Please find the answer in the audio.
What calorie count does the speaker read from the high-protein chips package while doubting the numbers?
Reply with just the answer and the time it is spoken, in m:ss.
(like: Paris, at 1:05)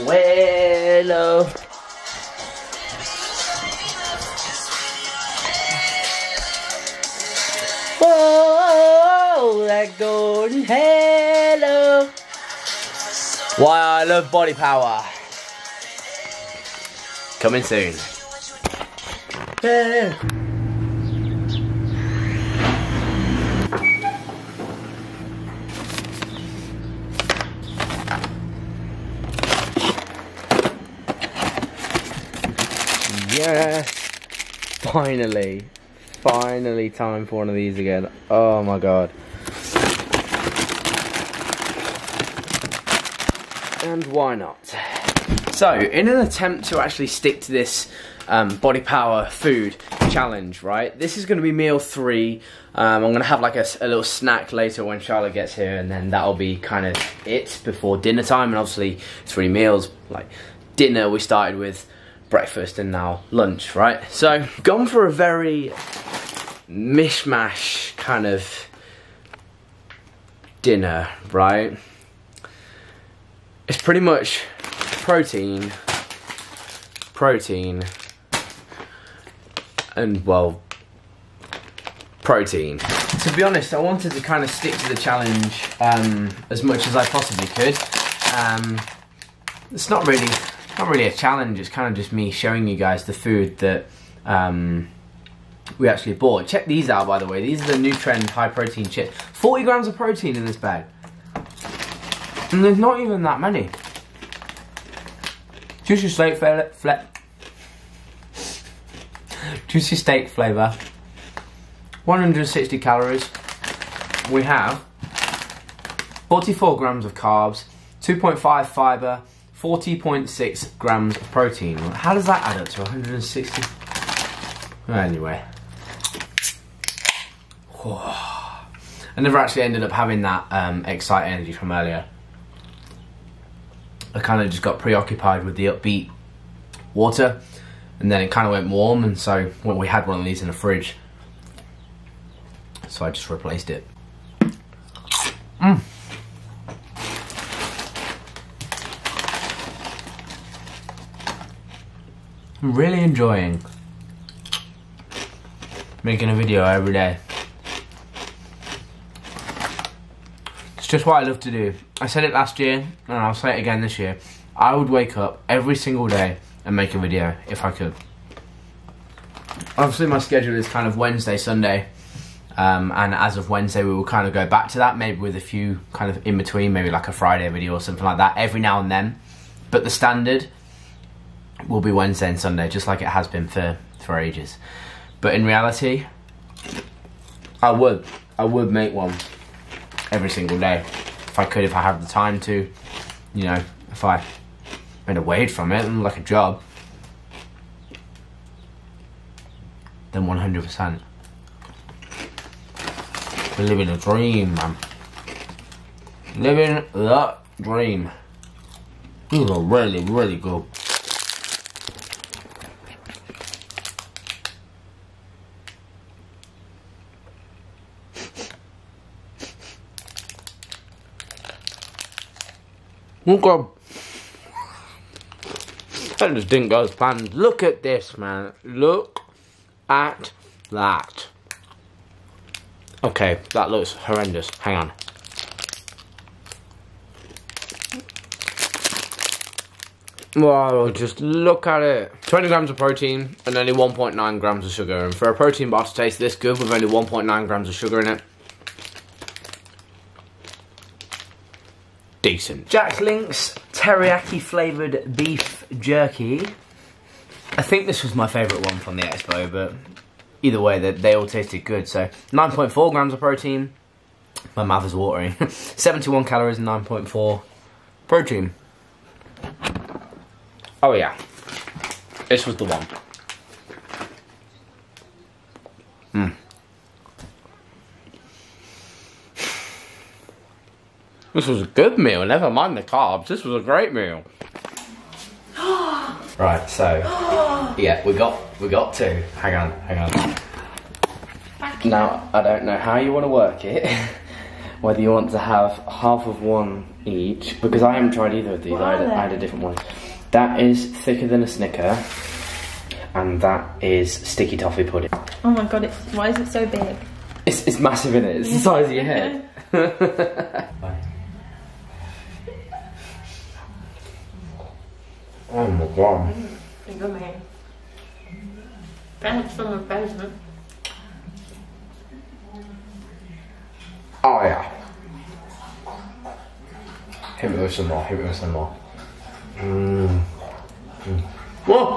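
160, at 1:52.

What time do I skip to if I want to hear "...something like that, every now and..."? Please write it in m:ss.
2:57.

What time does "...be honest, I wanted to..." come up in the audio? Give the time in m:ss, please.
1:23.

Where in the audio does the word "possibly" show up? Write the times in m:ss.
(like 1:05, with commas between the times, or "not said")
1:27.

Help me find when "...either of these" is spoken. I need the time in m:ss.
4:58.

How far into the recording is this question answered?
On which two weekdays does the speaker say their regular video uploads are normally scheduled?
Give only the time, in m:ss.
3:01.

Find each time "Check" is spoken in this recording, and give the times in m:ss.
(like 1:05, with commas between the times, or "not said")
1:36.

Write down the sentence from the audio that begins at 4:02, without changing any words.
20 grams of protein and only 1.9 grams of sugar.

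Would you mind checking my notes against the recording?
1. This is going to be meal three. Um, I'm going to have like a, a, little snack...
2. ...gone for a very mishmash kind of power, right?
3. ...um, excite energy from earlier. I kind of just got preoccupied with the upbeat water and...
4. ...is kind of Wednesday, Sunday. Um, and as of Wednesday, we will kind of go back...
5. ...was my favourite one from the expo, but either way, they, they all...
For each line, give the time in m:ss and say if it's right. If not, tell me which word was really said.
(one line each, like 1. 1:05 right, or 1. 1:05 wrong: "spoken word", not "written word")
1. 0:50 right
2. 1:04 wrong: "dinner", not "power"
3. 2:10 right
4. 2:50 right
5. 4:18 right.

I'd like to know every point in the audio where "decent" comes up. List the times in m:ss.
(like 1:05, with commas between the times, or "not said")
4:12.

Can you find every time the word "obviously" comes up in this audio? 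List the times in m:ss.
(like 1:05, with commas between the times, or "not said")
0:58, 2:49.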